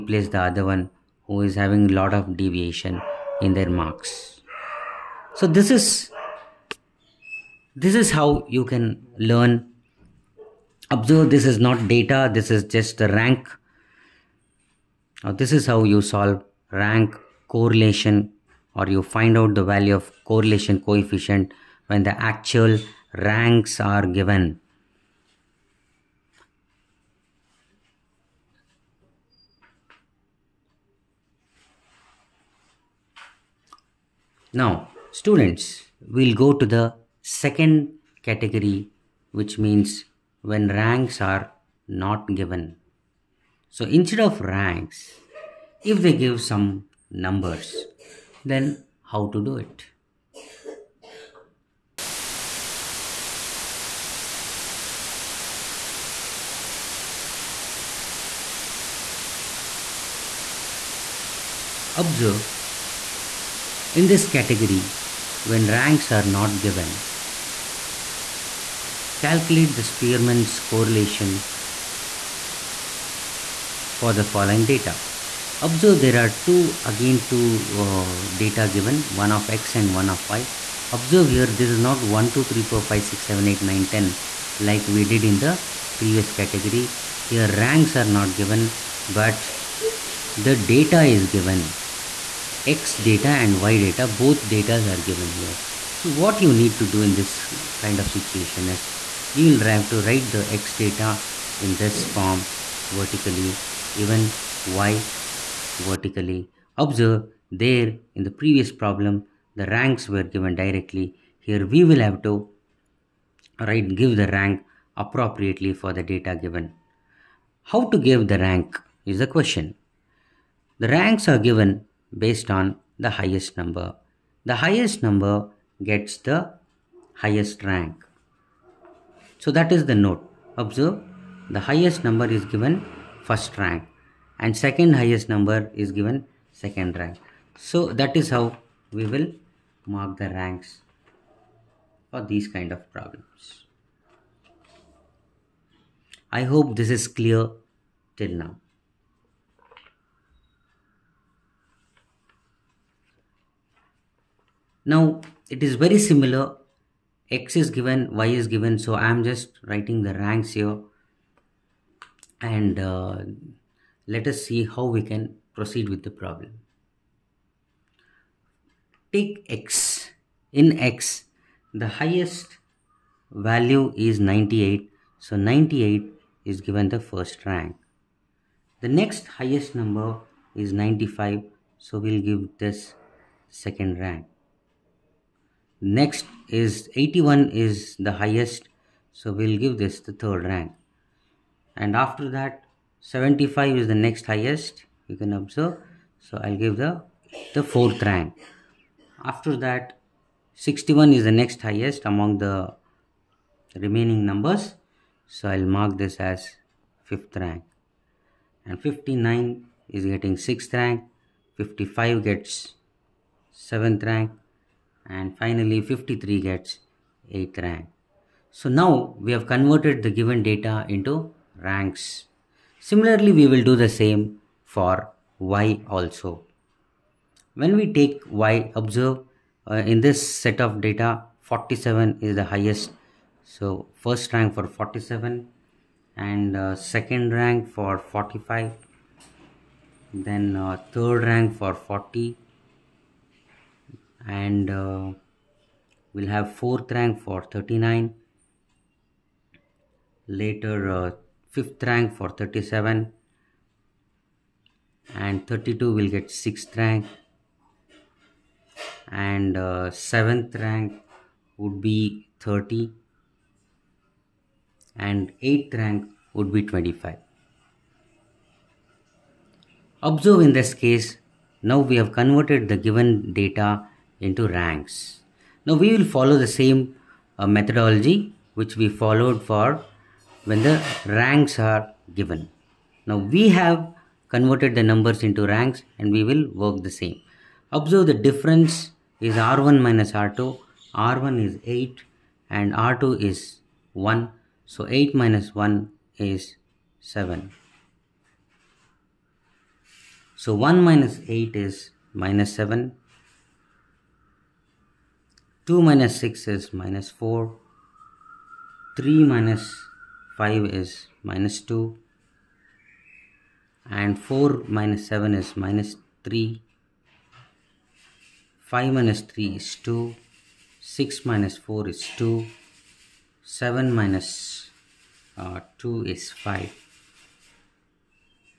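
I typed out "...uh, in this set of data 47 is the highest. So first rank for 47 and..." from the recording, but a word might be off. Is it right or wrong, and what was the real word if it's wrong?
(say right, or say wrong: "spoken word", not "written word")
right.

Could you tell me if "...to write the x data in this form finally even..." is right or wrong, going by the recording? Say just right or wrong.
wrong.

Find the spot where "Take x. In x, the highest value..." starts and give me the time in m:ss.
2:49.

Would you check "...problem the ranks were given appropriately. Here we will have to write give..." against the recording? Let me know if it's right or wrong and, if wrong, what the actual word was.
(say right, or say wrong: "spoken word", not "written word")
wrong: "directly", not "appropriately".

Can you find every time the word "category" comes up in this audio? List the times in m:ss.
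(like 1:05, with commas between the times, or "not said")
0:38, 1:04, 1:26.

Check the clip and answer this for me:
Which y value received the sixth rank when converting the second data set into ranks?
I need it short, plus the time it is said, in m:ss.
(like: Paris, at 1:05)
32, at 4:15.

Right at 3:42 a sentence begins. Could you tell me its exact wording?
Similarly, we will do the same for y also.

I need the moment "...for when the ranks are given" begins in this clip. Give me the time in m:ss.
4:39.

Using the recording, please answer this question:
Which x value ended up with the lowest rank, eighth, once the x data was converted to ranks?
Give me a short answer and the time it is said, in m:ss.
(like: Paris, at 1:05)
53, at 3:35.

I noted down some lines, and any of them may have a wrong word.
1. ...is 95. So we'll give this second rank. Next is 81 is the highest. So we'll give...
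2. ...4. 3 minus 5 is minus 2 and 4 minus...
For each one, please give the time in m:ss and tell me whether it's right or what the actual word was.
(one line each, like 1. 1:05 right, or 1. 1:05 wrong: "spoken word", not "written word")
1. 3:00 right
2. 5:07 right.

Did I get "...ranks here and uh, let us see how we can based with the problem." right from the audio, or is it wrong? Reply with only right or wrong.
wrong.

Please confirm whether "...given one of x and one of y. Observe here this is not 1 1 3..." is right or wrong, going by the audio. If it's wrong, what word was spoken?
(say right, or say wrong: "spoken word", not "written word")
wrong: "2", not "1".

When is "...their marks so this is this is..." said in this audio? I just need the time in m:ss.
0:03.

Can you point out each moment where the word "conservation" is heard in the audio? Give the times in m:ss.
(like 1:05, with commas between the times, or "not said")
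not said.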